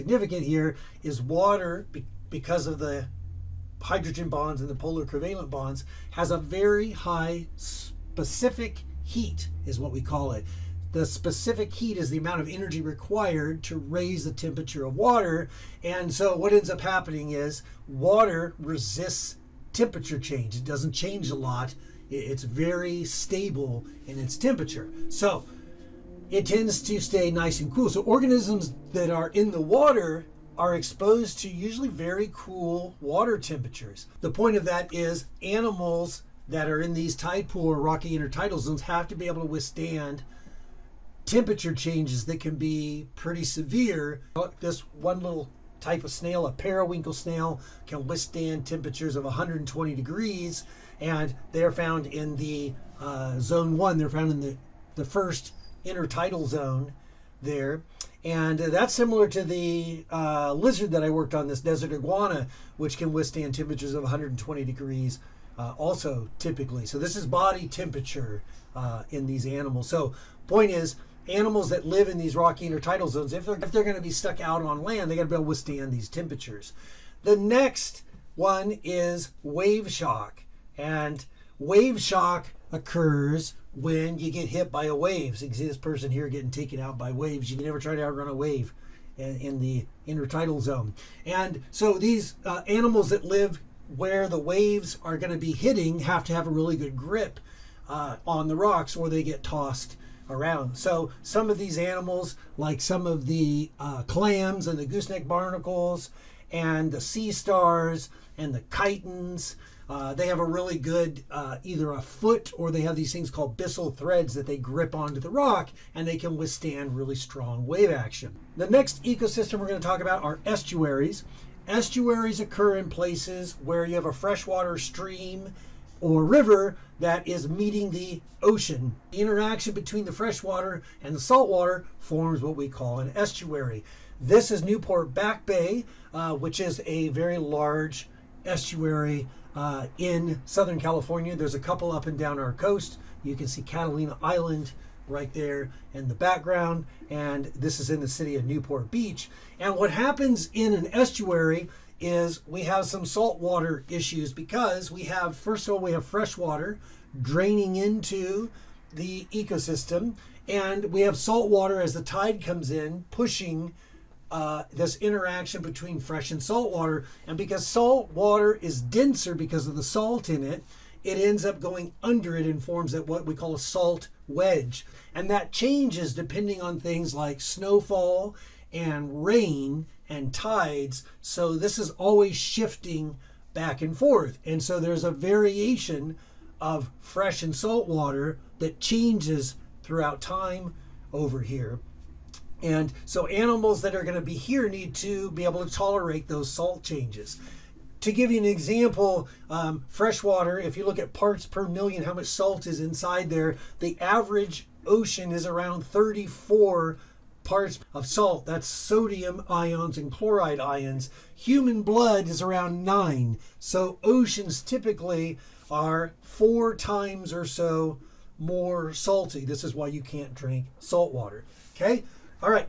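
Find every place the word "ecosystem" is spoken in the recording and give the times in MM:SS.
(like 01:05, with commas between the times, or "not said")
01:59, 02:39.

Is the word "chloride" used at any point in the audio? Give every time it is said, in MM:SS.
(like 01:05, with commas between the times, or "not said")
03:30.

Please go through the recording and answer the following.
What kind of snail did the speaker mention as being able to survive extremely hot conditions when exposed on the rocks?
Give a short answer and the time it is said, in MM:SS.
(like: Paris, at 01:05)
periwinkle snail, at 00:46.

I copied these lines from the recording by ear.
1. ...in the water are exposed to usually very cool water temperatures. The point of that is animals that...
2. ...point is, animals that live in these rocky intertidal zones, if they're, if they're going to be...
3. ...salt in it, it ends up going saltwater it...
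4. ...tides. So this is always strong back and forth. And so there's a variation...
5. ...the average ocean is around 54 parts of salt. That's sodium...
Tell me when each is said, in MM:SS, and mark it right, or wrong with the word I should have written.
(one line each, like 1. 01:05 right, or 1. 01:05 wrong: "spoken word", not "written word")
1. 00:29 right
2. 01:10 right
3. 02:49 wrong: "under", not "saltwater"
4. 03:00 wrong: "shifting", not "strong"
5. 03:23 wrong: "34", not "54".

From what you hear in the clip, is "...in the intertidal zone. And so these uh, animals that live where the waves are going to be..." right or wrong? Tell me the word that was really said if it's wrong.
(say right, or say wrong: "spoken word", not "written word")
right.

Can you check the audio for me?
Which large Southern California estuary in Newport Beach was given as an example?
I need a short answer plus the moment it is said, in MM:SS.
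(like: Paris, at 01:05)
Newport Back Bay, at 02:14.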